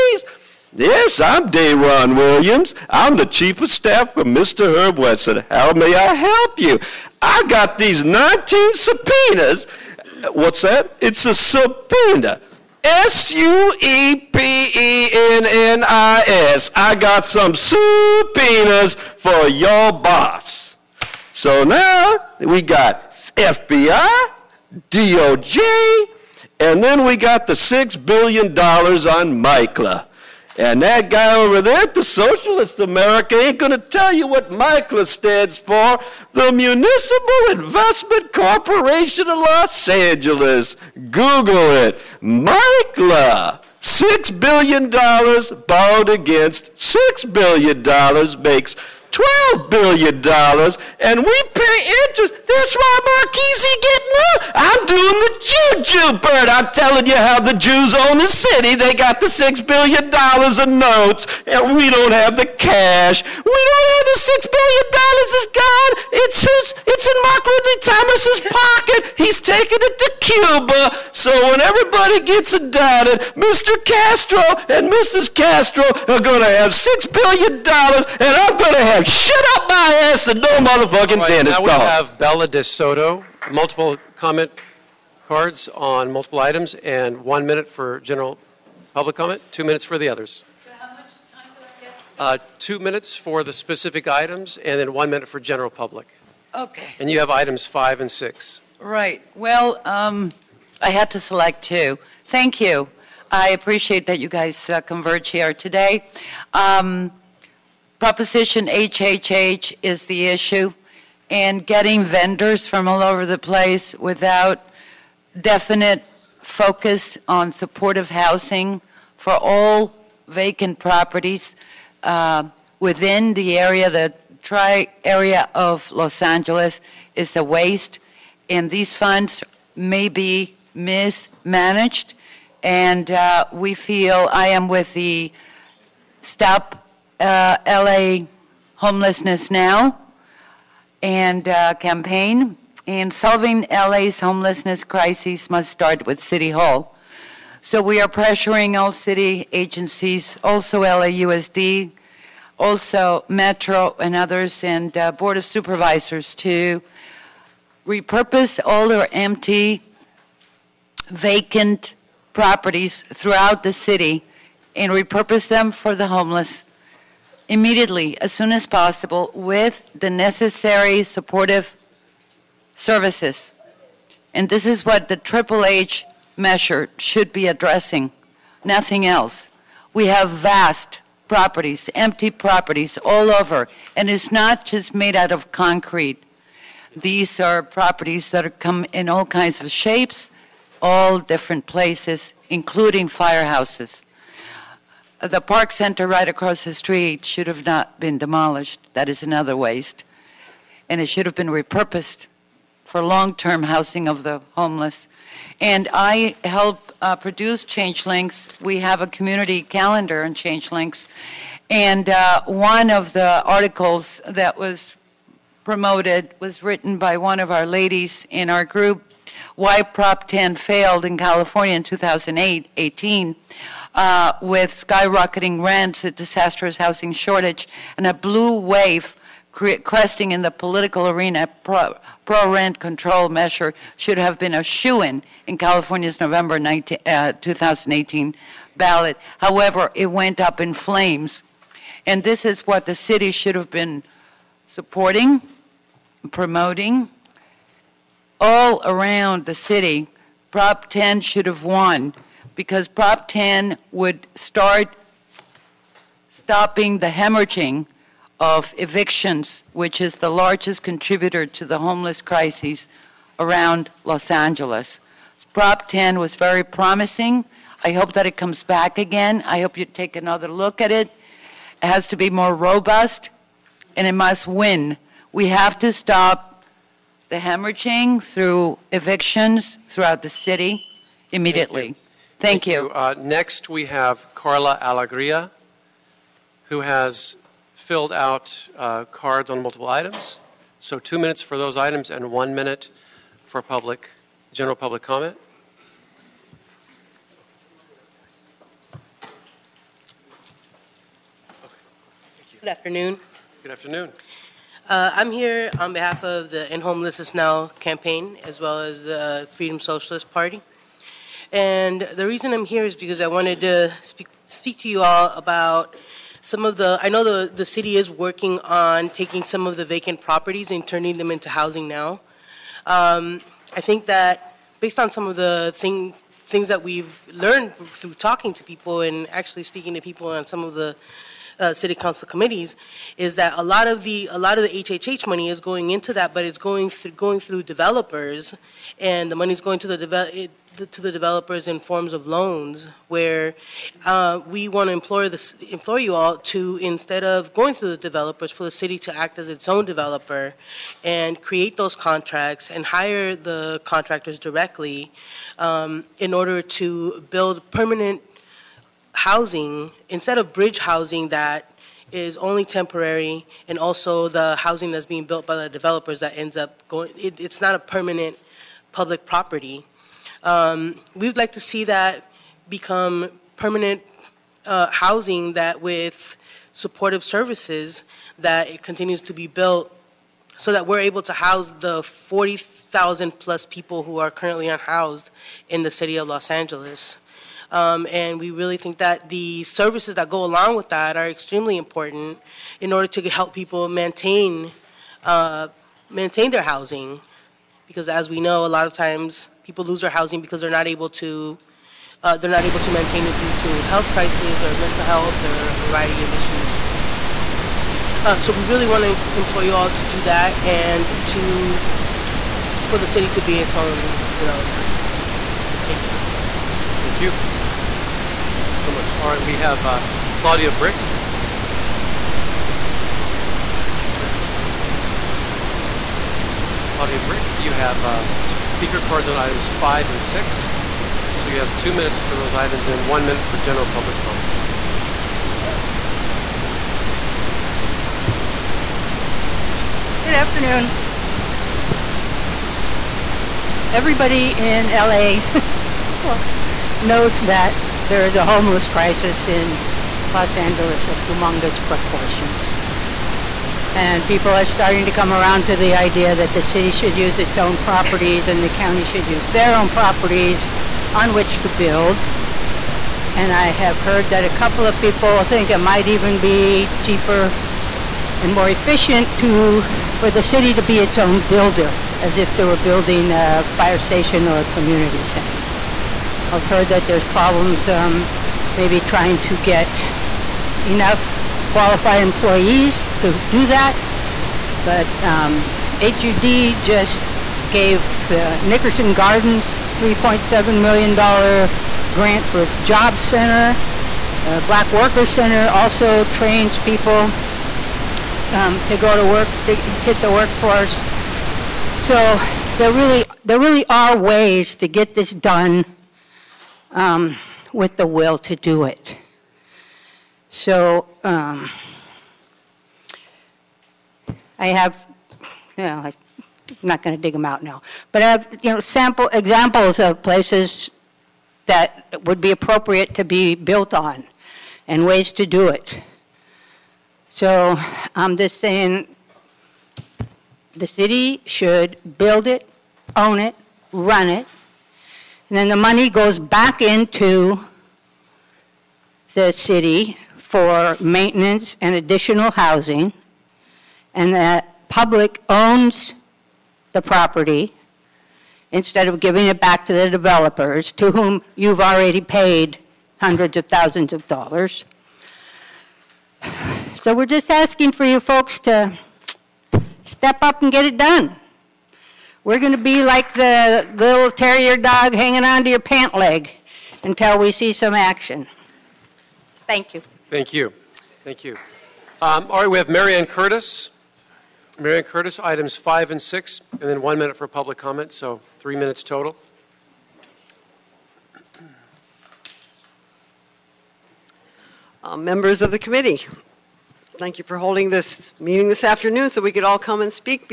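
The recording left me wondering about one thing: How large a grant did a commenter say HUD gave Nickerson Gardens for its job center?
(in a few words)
$3.7 million.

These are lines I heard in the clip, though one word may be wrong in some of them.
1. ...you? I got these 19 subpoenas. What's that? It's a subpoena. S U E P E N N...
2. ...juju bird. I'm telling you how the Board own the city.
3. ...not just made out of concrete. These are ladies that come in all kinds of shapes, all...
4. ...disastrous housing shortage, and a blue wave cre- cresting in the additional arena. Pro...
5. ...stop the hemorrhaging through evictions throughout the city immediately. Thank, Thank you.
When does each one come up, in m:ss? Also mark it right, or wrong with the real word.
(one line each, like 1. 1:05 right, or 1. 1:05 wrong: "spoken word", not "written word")
1. 0:06 right
2. 0:55 wrong: "Jews", not "Board"
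3. 3:04 wrong: "properties", not "ladies"
4. 3:46 wrong: "political", not "additional"
5. 4:35 right.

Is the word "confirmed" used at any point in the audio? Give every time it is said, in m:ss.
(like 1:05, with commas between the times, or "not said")
not said.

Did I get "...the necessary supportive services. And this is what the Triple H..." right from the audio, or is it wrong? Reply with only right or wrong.
right.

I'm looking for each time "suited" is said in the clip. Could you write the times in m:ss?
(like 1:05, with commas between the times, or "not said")
not said.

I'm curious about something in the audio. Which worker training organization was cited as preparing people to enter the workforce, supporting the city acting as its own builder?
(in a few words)
Black Worker Center.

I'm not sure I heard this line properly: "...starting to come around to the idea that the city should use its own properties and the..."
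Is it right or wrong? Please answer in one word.
right.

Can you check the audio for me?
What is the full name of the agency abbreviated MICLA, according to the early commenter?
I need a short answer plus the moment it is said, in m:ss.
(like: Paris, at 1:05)
Municipal Investment Corporation of Los Angeles, at 0:36.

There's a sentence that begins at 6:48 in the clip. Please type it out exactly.
Uh, so we really want to employ you all to do that and to for the city to be its own developer.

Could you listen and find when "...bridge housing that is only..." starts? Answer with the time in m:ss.
6:00.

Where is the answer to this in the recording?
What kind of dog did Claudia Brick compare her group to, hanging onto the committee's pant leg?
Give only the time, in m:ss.
9:24.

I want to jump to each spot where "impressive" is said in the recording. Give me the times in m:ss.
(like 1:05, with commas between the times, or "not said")
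not said.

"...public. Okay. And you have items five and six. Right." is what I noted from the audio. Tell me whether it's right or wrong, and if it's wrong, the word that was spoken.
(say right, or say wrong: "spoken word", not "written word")
right.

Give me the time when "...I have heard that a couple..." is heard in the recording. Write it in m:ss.
7:43.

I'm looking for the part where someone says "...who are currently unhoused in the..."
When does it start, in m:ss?
6:24.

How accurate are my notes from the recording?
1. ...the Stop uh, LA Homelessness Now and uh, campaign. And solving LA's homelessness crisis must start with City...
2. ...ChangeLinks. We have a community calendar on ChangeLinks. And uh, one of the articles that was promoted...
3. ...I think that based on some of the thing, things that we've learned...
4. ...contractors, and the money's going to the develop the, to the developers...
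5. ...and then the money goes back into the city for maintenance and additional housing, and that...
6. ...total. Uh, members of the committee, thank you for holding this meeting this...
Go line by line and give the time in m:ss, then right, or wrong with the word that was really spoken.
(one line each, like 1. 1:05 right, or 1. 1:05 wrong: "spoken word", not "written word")
1. 2:14 right
2. 3:27 right
3. 5:23 right
4. 5:37 wrong: "developers", not "contractors"
5. 8:55 right
6. 9:39 right.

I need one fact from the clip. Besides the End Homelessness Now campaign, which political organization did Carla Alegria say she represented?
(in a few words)
Freedom Socialist Party.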